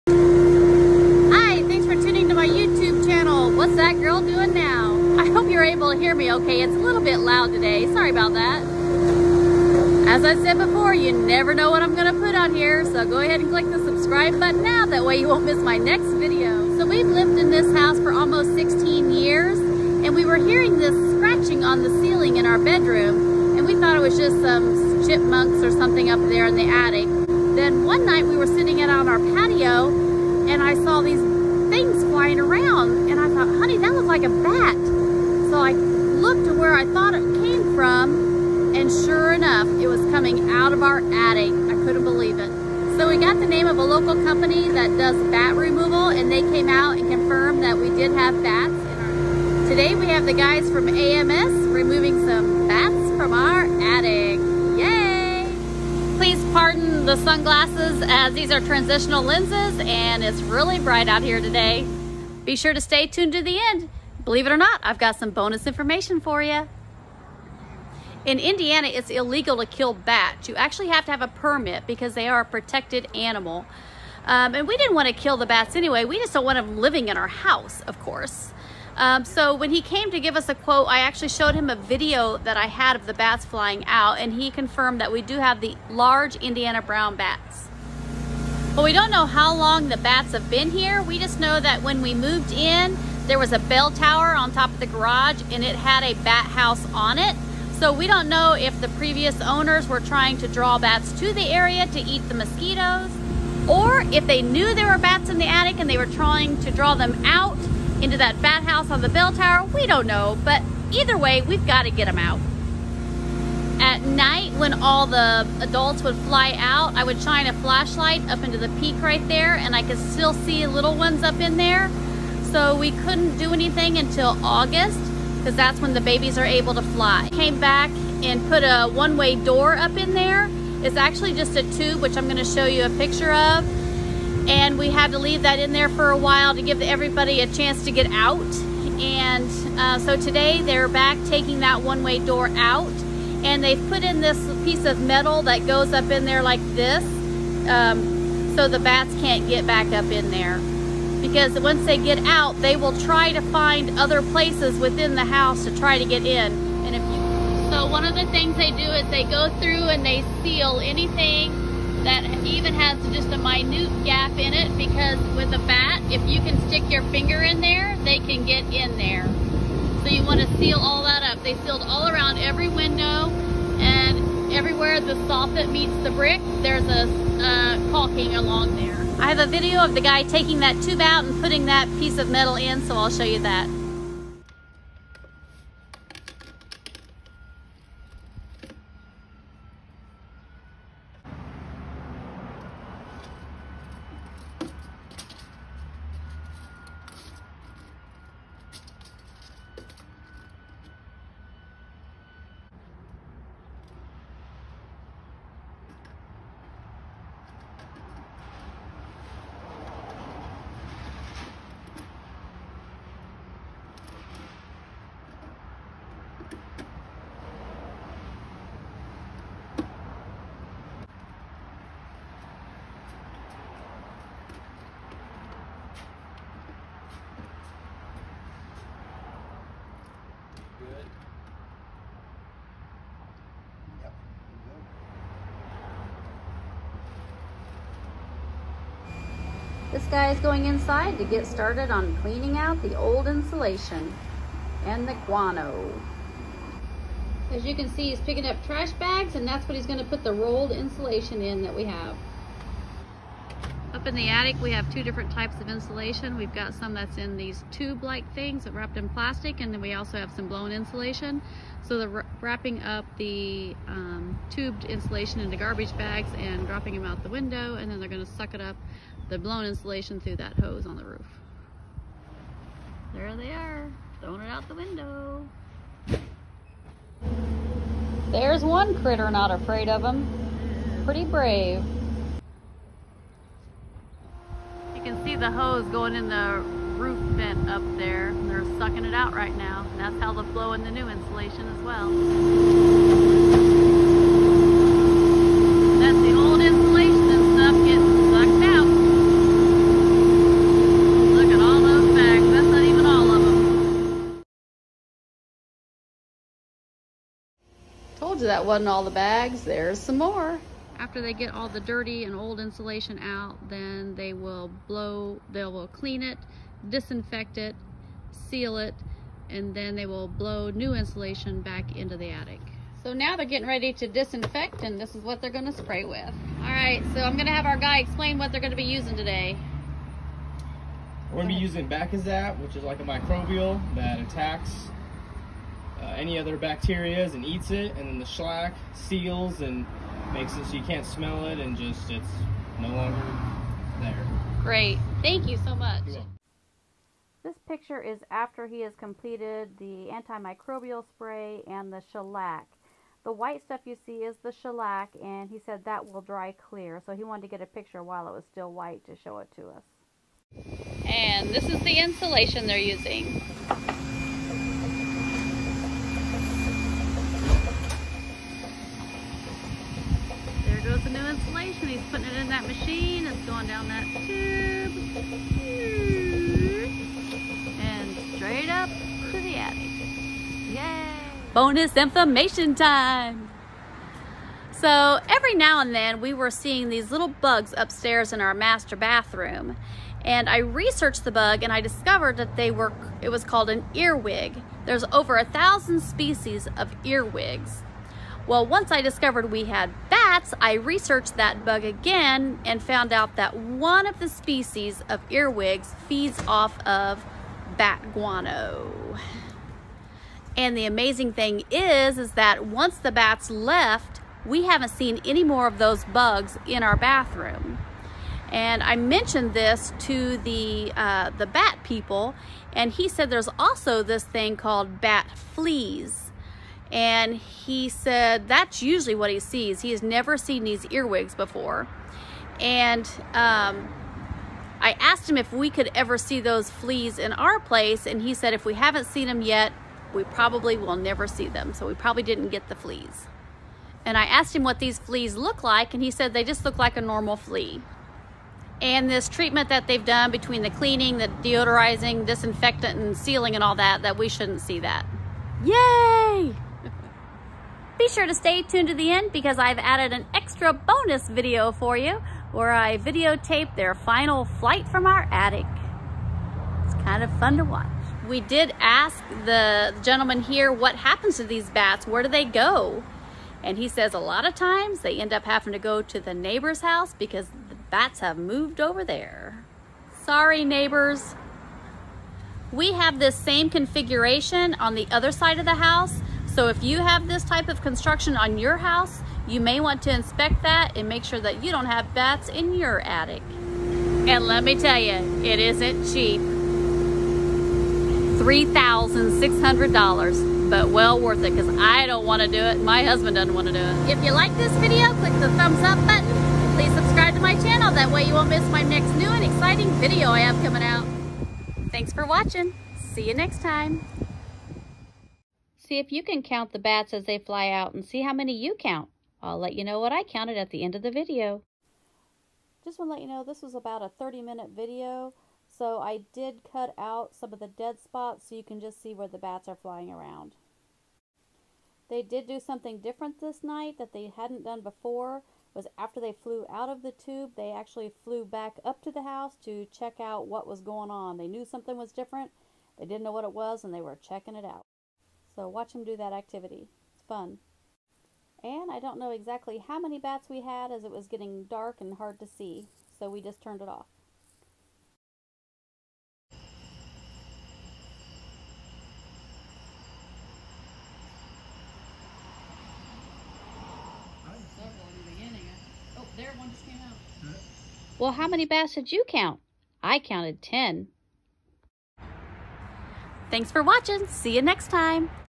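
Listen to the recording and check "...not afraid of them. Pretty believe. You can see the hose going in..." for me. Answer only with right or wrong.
wrong.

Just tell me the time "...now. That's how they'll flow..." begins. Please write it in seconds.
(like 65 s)
289 s.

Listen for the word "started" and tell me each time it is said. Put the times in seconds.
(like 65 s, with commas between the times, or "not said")
241 s.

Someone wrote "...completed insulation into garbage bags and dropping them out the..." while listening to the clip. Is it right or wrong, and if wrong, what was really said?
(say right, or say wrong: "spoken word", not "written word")
wrong: "tubed", not "completed".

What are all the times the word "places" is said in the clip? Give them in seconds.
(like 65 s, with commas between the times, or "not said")
154 s, 437 s.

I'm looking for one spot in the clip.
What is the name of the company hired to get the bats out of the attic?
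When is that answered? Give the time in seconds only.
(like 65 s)
50 s.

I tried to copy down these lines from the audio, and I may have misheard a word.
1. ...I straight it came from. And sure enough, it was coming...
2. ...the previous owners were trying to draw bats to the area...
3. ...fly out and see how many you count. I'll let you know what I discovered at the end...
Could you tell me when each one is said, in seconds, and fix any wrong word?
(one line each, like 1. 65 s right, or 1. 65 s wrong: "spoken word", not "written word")
1. 36 s wrong: "thought", not "straight"
2. 98 s right
3. 517 s wrong: "counted", not "discovered".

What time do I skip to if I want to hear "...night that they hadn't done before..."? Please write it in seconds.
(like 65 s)
533 s.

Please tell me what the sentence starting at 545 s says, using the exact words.
So watch them do that activity.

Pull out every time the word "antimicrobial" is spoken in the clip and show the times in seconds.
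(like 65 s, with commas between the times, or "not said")
350 s.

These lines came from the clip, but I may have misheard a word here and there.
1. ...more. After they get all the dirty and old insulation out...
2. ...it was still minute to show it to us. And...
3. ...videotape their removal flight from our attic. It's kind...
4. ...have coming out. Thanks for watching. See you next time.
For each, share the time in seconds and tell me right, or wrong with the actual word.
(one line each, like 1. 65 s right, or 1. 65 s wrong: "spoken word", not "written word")
1. 310 s right
2. 358 s wrong: "white", not "minute"
3. 462 s wrong: "final", not "removal"
4. 510 s right.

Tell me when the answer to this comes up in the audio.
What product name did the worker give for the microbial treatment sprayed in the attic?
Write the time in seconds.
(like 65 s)
331 s.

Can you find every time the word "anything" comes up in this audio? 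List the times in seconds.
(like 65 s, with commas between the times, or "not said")
123 s, 160 s.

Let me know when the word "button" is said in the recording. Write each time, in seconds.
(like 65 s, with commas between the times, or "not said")
14 s, 506 s.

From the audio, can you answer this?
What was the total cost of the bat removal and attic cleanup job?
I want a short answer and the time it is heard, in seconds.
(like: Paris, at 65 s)
$3,600, at 496 s.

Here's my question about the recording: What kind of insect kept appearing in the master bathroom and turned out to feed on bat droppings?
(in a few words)
Earwig.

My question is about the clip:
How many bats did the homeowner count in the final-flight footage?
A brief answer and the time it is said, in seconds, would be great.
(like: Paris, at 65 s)
10, at 570 s.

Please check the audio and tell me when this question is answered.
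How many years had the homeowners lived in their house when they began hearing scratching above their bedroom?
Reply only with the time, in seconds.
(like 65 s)
18 s.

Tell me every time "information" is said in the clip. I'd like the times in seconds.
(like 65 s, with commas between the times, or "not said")
65 s, 381 s.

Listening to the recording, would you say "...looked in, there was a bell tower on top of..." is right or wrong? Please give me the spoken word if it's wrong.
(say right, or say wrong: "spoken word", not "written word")
wrong: "moved", not "looked".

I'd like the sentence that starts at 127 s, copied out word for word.
Came back and put a one-way door up in there.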